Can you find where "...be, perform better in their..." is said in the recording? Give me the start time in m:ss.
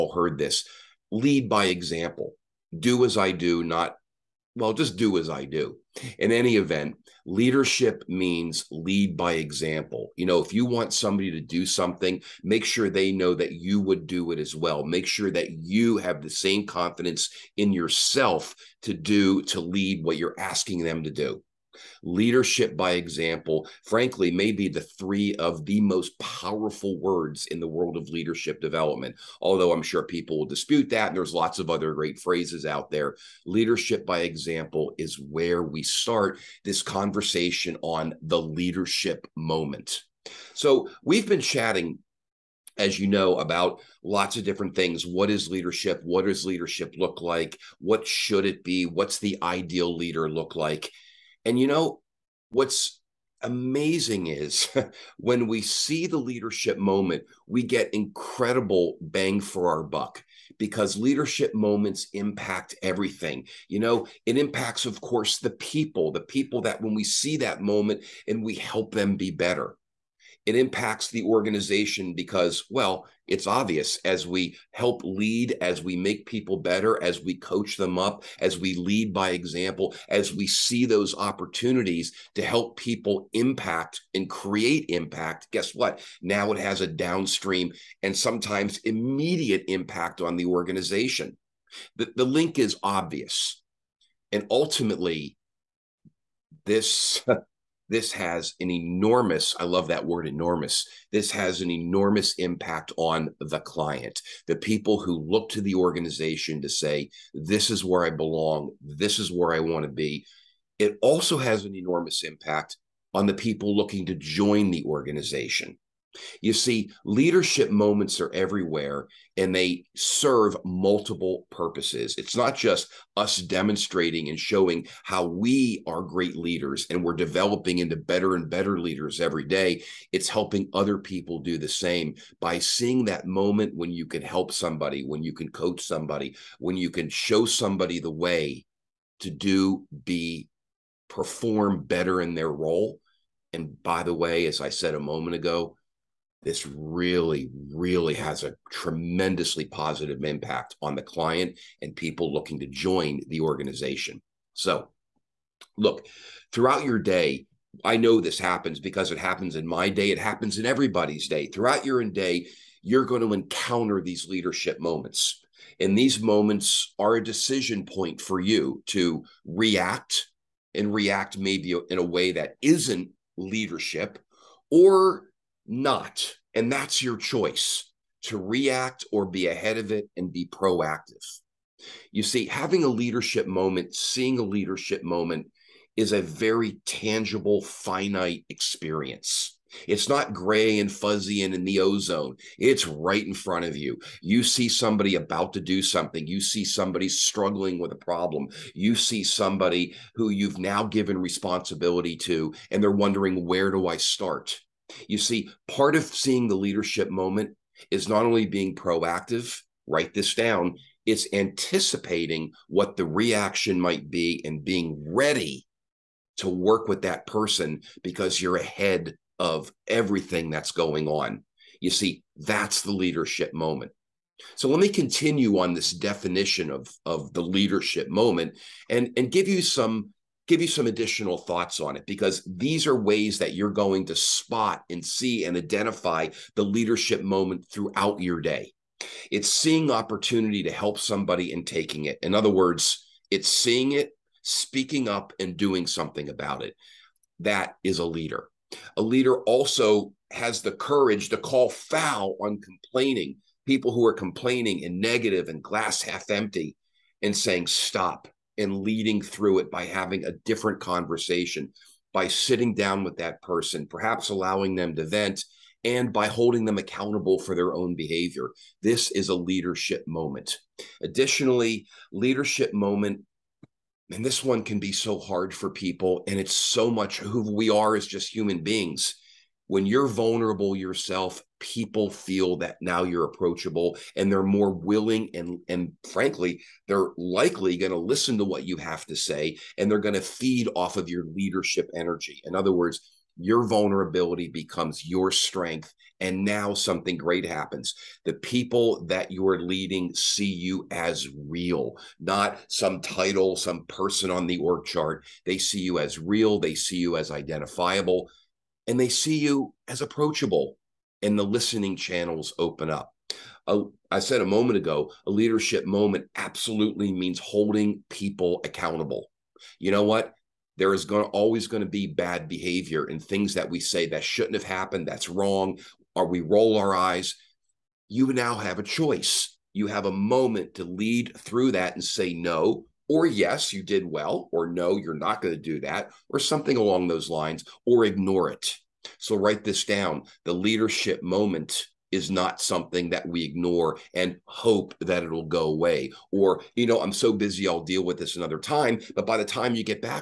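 2:20.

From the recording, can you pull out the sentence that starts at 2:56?
And that's your choice to react or be ahead of it and be proactive.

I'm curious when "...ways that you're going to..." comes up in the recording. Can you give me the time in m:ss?
3:52.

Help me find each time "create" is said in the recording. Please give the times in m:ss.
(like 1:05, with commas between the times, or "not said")
1:24.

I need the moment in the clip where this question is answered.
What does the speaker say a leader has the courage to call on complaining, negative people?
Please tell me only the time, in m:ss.
4:11.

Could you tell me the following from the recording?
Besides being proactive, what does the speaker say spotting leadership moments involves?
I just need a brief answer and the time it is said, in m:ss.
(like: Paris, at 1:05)
anticipating, at 3:31.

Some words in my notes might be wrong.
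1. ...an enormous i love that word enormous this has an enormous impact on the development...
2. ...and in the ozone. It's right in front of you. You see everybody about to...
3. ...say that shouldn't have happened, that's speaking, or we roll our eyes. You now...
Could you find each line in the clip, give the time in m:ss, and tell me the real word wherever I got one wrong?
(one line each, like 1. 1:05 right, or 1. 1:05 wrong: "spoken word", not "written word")
1. 1:38 wrong: "client", not "development"
2. 3:11 wrong: "somebody", not "everybody"
3. 5:23 wrong: "wrong", not "speaking".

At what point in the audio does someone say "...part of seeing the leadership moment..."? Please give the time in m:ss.
3:25.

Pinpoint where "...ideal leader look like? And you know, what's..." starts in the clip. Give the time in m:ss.
0:49.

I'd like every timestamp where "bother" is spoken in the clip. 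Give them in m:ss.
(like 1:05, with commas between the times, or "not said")
not said.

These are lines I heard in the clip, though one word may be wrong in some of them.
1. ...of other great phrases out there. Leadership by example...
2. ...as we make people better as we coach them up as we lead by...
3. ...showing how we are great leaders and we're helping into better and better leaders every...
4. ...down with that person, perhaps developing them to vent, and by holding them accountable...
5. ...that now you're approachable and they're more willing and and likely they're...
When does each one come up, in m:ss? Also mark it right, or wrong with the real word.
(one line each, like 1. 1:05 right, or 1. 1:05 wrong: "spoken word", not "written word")
1. 0:31 right
2. 1:15 right
3. 2:04 wrong: "developing", not "helping"
4. 4:22 wrong: "allowing", not "developing"
5. 4:42 wrong: "frankly", not "likely".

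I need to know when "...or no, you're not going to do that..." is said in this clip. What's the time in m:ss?
5:34.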